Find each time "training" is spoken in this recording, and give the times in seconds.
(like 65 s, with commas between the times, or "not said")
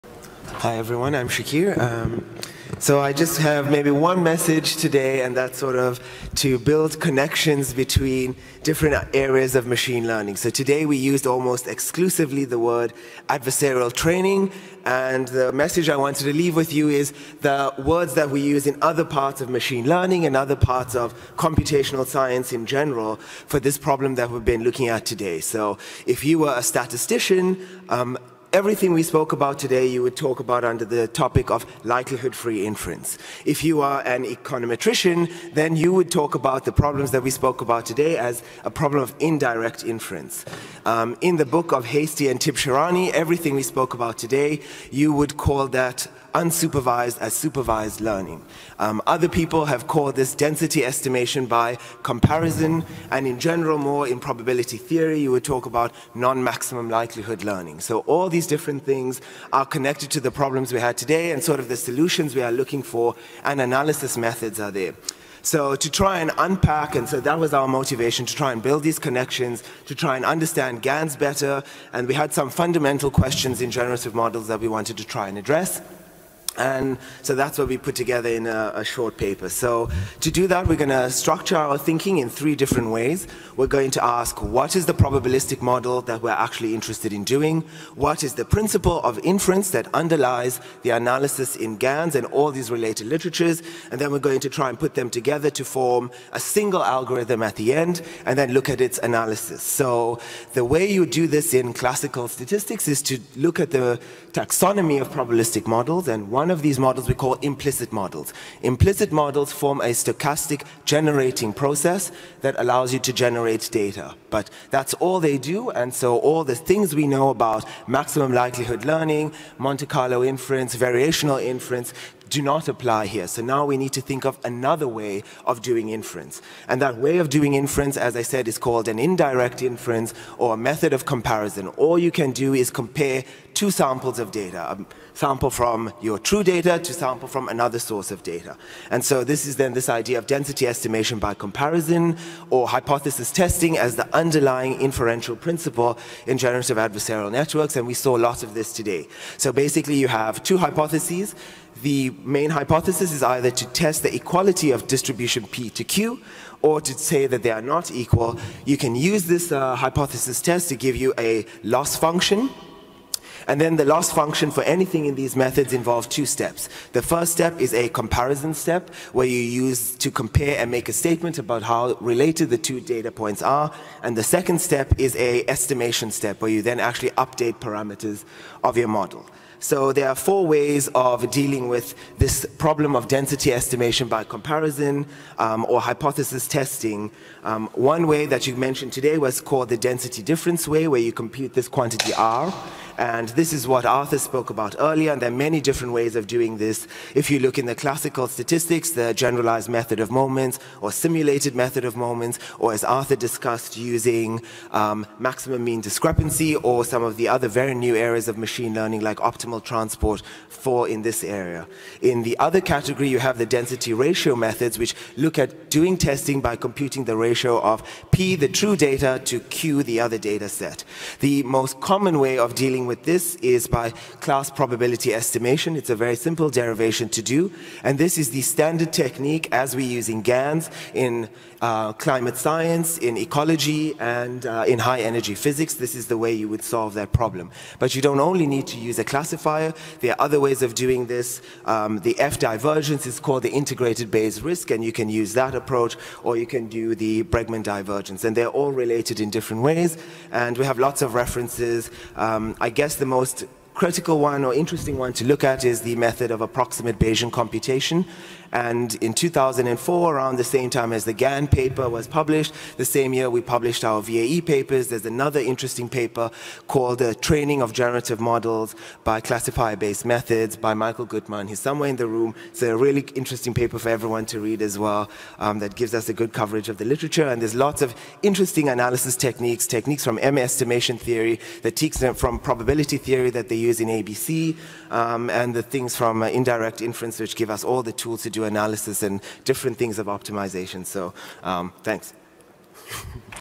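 13 s, 267 s.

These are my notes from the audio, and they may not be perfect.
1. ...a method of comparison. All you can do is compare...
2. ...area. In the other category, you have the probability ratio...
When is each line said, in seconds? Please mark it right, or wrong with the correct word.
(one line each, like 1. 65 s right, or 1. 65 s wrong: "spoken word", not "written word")
1. 130 s right
2. 211 s wrong: "density", not "probability".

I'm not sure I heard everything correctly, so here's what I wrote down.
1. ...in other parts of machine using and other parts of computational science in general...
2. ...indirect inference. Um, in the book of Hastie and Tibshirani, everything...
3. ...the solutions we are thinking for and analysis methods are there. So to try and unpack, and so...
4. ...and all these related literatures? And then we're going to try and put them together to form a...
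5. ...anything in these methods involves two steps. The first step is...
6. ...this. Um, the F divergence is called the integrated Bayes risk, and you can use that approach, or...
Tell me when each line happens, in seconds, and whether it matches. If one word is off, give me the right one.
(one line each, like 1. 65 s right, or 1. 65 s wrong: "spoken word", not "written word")
1. 18 s wrong: "learning", not "using"
2. 39 s right
3. 61 s wrong: "looking", not "thinking"
4. 92 s right
5. 164 s right
6. 241 s right.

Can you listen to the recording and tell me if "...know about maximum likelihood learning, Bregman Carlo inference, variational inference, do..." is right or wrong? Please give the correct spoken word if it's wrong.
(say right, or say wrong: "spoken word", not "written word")
wrong: "Monte", not "Bregman".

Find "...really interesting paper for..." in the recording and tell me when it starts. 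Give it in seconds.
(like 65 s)
272 s.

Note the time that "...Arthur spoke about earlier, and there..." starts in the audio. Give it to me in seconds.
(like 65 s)
193 s.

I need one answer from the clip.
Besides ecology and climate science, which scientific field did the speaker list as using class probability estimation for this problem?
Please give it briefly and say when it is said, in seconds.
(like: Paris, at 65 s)
High energy physics, at 234 s.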